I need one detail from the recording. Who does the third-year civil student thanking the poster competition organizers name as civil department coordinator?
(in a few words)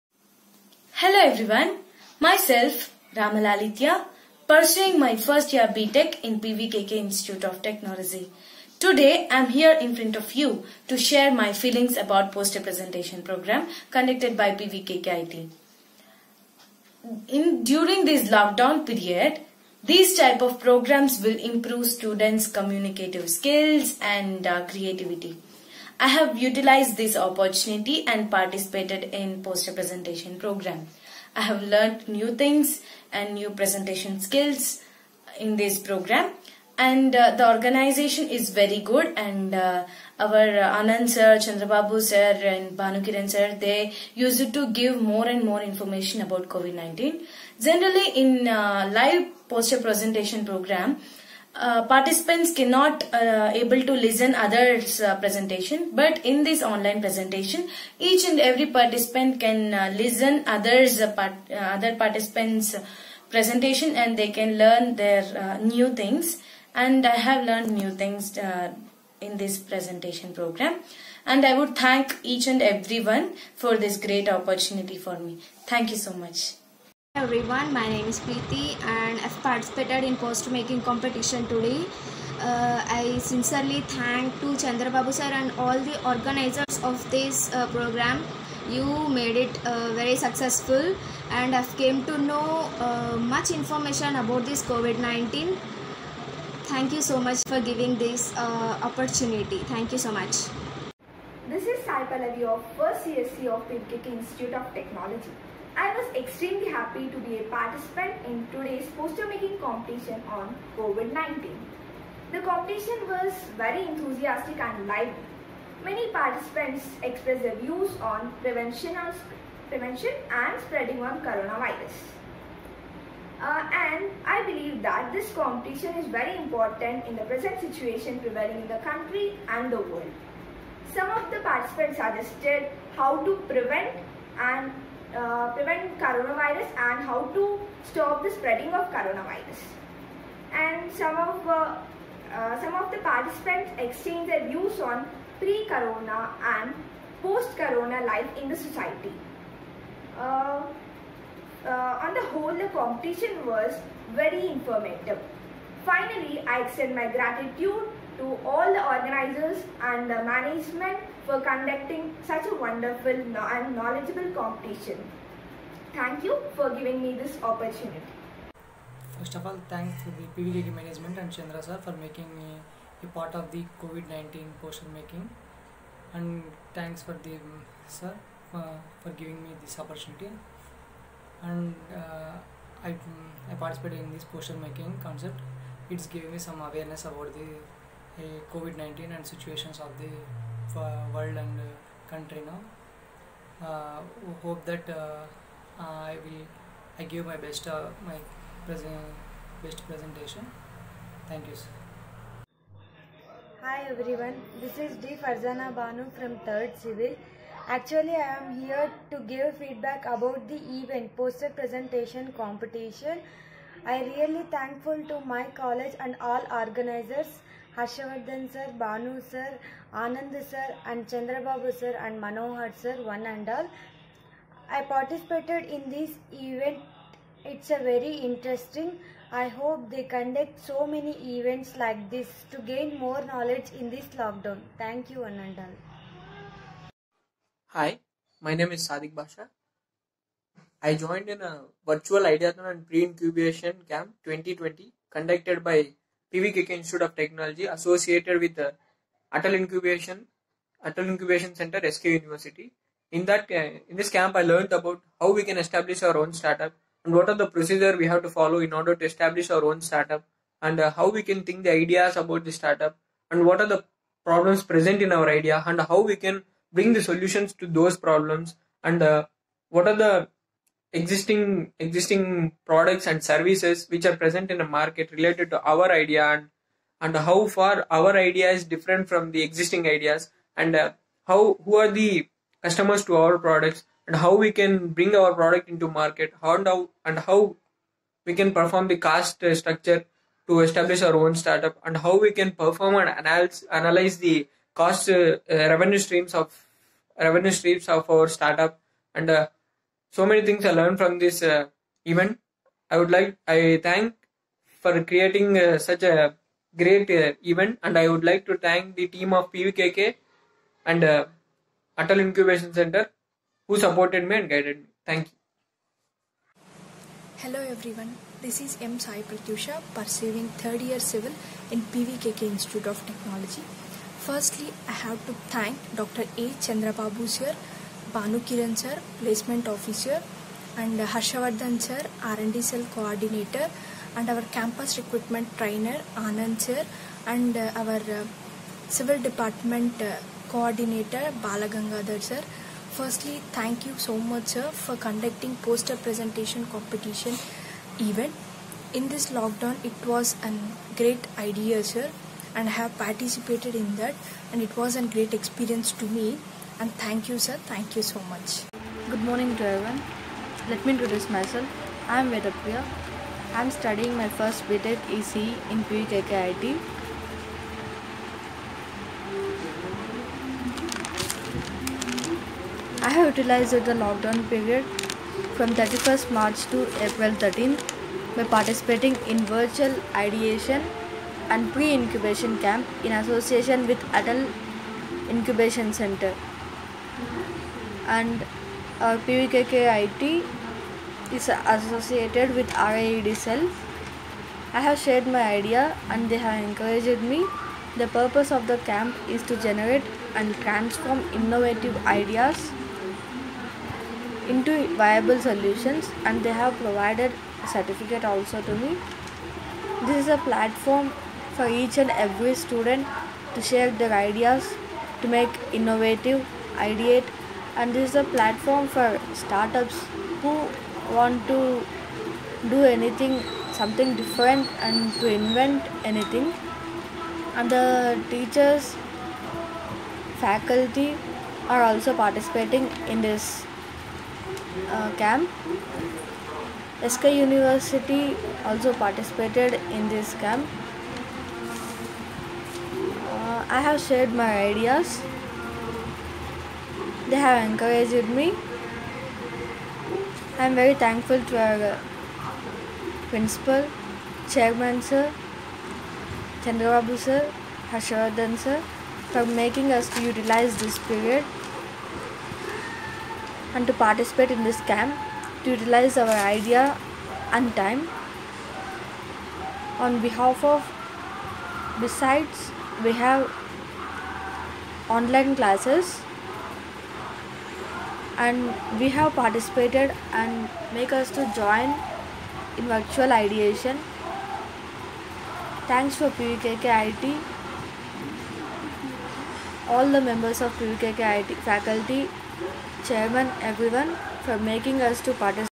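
Balagangadhar.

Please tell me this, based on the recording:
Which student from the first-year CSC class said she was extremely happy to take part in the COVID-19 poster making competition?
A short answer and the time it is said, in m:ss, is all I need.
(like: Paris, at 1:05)
Sai Pallavi, at 1:41.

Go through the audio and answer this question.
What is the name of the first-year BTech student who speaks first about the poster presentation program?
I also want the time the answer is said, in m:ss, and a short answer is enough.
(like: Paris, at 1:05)
Ramalalitya, at 0:03.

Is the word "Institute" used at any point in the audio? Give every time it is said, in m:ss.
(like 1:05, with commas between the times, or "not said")
0:06, 1:44, 4:06, 5:22.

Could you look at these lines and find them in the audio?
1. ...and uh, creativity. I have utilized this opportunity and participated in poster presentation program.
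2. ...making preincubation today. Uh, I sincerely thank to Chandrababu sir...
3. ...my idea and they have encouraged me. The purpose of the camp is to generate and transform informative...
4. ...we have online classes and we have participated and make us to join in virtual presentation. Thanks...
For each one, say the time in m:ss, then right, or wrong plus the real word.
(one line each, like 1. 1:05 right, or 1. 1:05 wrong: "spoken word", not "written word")
1. 0:24 right
2. 1:20 wrong: "competition", not "preincubation"
3. 6:35 wrong: "innovative", not "informative"
4. 7:53 wrong: "ideation", not "presentation".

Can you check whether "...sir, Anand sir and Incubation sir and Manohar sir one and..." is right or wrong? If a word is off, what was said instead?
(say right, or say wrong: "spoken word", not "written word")
wrong: "Chandrababu", not "Incubation".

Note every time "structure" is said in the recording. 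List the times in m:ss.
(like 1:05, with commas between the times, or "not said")
4:49.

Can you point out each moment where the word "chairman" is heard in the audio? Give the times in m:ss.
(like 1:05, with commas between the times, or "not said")
7:34, 8:13.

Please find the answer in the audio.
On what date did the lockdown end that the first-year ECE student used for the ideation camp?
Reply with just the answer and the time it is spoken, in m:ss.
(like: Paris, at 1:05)
April 13th, at 6:17.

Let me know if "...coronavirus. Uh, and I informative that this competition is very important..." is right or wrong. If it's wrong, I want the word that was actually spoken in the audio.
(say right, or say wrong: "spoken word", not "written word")
wrong: "believe", not "informative".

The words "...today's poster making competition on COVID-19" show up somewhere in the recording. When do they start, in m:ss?
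1:48.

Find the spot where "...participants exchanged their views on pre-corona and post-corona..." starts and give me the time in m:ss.
2:22.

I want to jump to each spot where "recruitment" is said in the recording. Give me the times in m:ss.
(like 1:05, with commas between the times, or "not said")
5:34.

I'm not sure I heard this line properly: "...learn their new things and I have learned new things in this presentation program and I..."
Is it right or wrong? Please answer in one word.
right.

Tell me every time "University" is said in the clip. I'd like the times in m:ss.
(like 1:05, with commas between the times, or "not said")
4:12, 7:17.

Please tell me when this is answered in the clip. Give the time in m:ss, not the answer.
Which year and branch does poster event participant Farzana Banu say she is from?
3:26.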